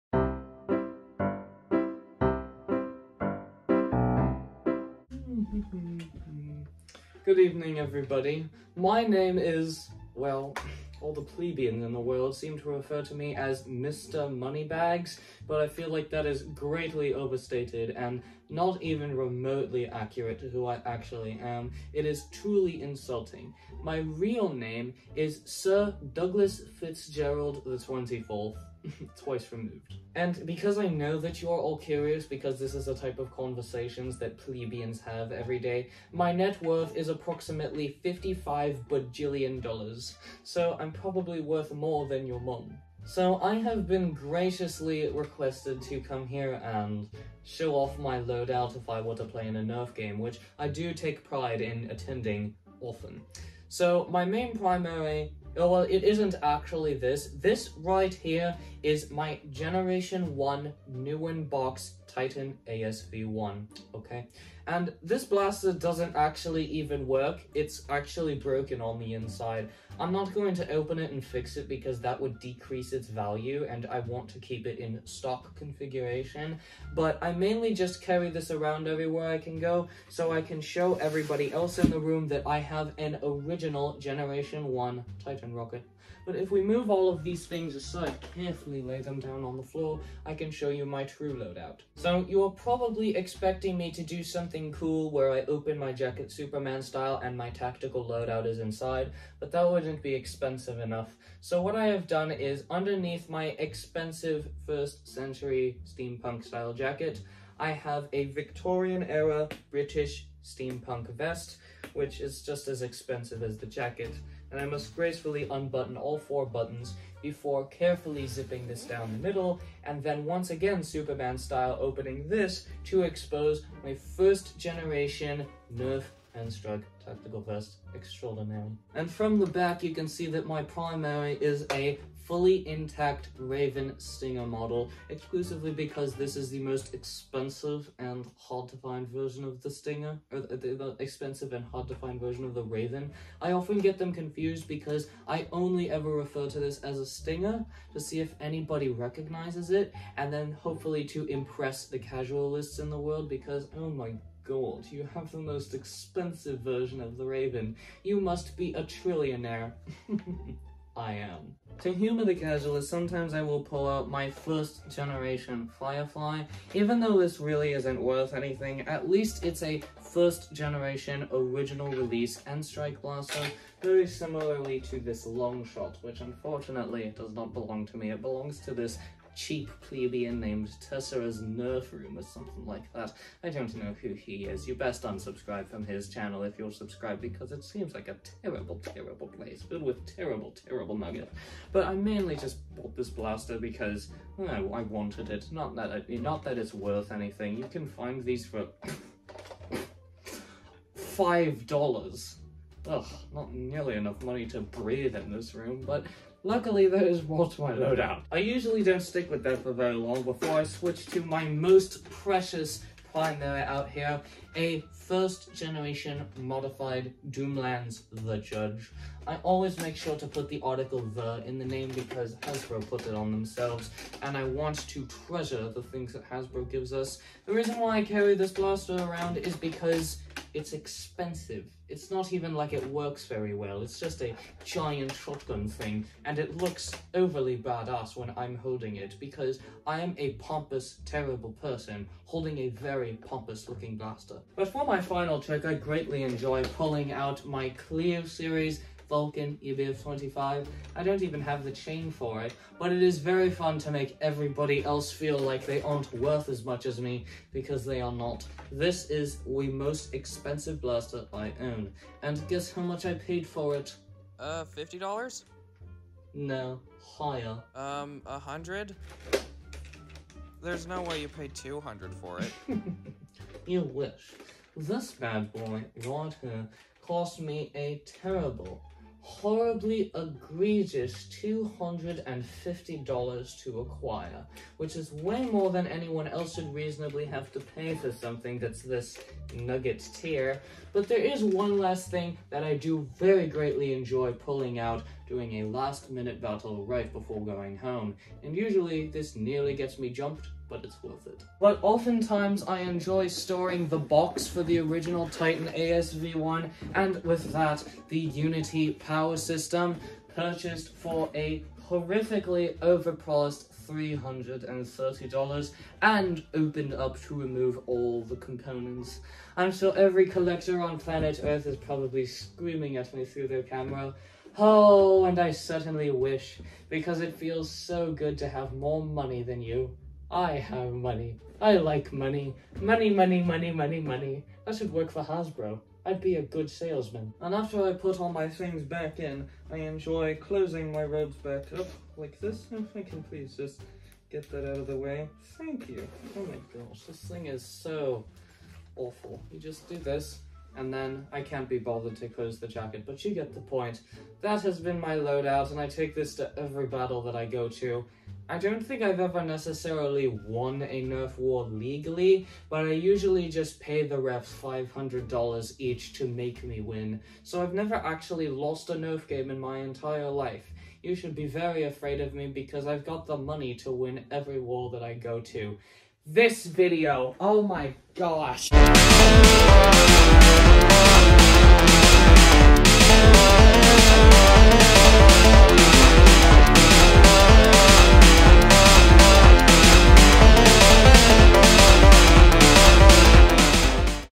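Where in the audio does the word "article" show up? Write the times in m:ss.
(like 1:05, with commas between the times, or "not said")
3:40.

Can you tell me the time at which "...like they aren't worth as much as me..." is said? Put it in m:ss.
4:15.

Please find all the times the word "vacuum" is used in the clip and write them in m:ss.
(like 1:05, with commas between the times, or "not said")
not said.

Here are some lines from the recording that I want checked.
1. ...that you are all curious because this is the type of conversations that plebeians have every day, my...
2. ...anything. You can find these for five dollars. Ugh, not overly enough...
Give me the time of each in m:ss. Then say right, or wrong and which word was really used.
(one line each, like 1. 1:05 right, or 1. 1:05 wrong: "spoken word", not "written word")
1. 0:31 right
2. 3:17 wrong: "nearly", not "overly".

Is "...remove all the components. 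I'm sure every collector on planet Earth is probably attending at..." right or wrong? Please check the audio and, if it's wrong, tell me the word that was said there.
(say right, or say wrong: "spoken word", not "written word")
wrong: "screaming", not "attending".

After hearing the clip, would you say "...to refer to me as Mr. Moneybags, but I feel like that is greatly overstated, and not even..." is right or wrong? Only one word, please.
right.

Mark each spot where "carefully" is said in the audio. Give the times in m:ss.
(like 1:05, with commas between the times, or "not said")
1:28, 1:57.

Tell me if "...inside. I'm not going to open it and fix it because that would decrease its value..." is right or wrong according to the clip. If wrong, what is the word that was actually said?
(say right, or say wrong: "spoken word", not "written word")
right.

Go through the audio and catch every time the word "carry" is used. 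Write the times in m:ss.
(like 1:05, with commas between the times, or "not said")
1:18, 3:48.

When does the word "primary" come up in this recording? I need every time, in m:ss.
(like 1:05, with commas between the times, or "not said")
0:54, 2:10, 3:33.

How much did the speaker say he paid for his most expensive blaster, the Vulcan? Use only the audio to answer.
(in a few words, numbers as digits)
$250.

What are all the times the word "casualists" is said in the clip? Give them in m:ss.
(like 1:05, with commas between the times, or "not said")
2:31, 2:42.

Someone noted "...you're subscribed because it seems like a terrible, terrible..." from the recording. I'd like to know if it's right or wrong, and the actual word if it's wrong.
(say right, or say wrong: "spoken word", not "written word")
right.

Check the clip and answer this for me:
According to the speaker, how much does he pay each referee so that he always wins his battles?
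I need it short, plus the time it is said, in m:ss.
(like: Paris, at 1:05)
$500, at 6:04.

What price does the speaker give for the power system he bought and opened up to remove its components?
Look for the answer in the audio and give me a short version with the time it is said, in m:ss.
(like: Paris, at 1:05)
$330, at 5:13.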